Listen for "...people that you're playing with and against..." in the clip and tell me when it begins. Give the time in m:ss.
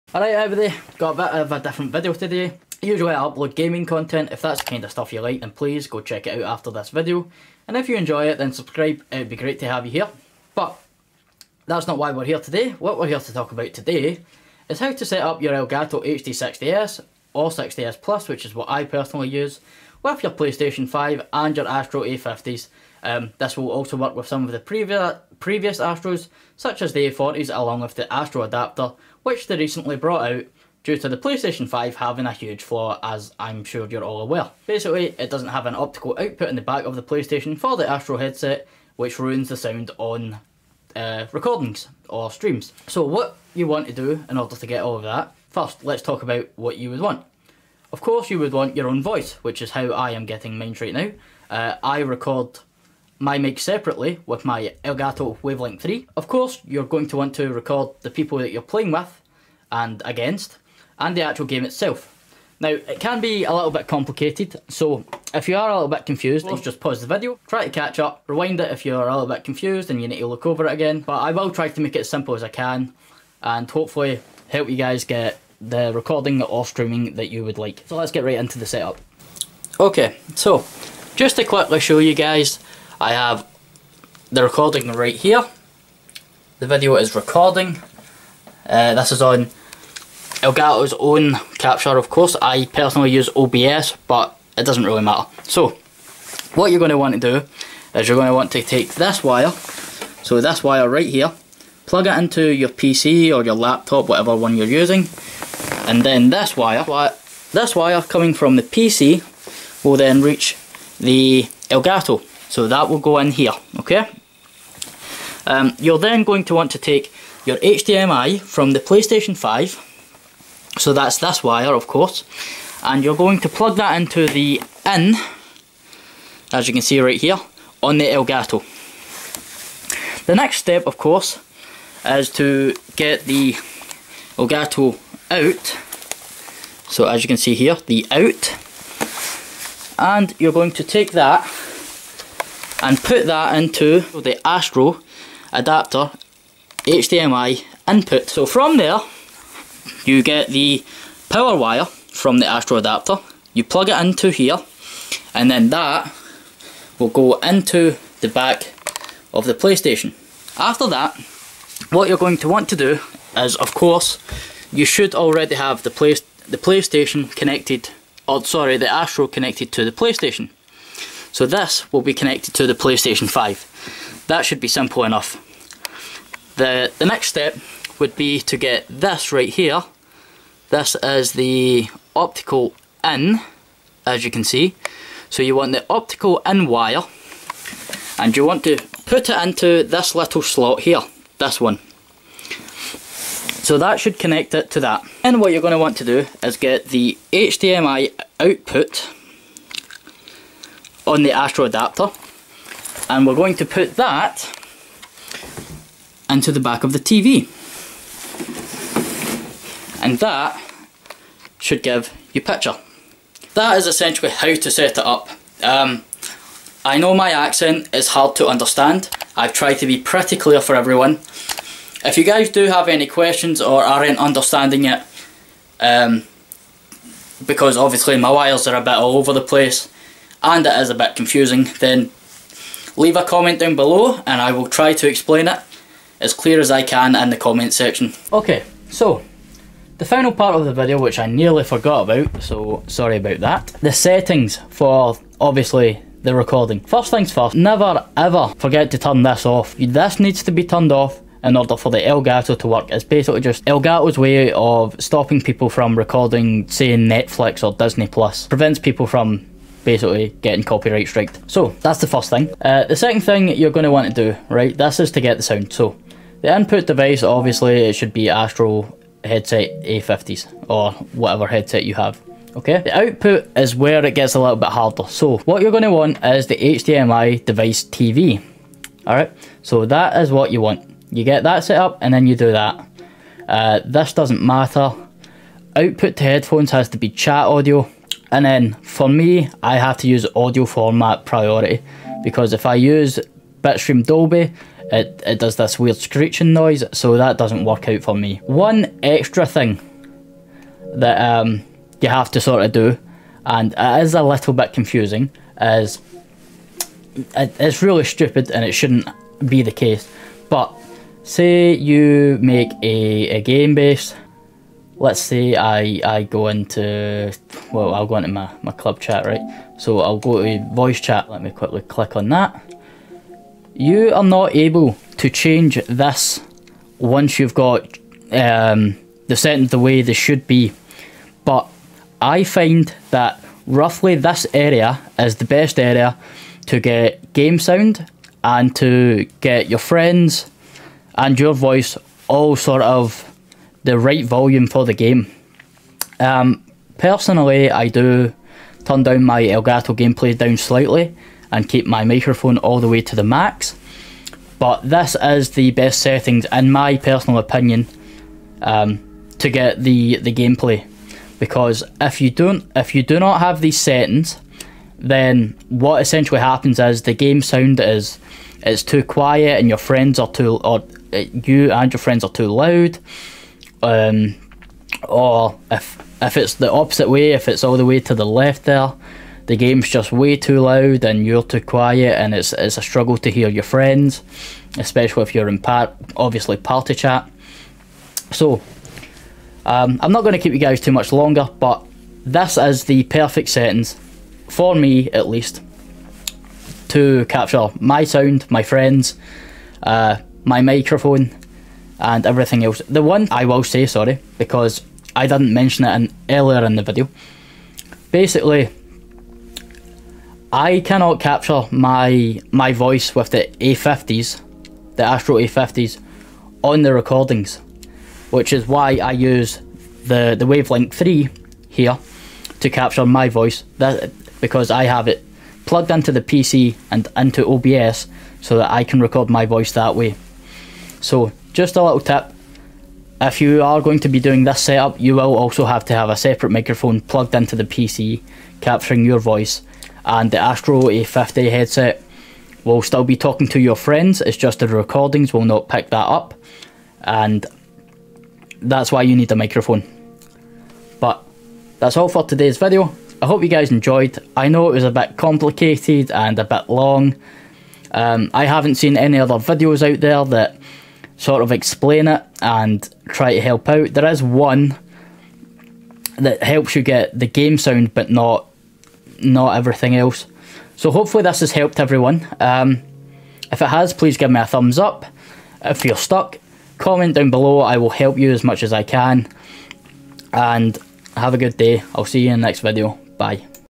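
0:58.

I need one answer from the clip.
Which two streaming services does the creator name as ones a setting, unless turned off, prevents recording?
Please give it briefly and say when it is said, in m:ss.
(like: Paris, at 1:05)
Netflix or Disney Plus, at 4:16.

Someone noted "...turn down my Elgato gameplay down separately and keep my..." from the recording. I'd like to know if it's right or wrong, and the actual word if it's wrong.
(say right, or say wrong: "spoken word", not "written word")
wrong: "slightly", not "separately".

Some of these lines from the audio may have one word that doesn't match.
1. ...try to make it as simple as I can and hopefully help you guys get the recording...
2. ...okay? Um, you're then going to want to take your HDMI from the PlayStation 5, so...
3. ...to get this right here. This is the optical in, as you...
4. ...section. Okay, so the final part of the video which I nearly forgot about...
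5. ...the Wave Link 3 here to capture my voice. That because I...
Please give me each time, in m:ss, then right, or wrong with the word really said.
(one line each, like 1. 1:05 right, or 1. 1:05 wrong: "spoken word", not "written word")
1. 1:11 right
2. 1:53 right
3. 2:58 right
4. 3:57 right
5. 7:00 right.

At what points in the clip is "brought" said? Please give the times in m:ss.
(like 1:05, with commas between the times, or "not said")
0:29.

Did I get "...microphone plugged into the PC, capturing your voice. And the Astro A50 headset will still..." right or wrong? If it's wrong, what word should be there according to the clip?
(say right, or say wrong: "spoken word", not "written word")
right.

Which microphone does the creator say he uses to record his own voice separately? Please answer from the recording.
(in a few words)
Elgato Wave Link 3.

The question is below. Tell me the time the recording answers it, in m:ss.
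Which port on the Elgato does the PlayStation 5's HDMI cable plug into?
2:04.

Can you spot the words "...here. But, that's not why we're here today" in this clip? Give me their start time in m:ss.
0:09.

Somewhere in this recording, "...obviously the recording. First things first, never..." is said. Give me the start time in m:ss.
4:05.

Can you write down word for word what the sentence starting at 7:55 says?
If you're stuck, comment down below.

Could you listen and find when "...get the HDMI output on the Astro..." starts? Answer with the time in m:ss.
3:16.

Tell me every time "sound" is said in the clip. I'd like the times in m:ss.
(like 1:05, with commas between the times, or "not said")
0:39, 4:25, 5:37, 6:07, 6:38, 7:47.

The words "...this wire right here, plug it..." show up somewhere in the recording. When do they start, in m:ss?
1:40.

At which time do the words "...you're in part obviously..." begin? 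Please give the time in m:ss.
6:25.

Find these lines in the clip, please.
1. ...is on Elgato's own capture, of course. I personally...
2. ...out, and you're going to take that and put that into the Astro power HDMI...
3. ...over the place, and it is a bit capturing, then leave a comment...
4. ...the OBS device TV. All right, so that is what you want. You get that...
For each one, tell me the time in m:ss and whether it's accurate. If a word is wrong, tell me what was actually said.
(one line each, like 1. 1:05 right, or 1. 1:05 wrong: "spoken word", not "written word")
1. 1:29 right
2. 2:18 wrong: "adapter", not "power"
3. 3:49 wrong: "confusing", not "capturing"
4. 4:36 wrong: "HDMI", not "OBS".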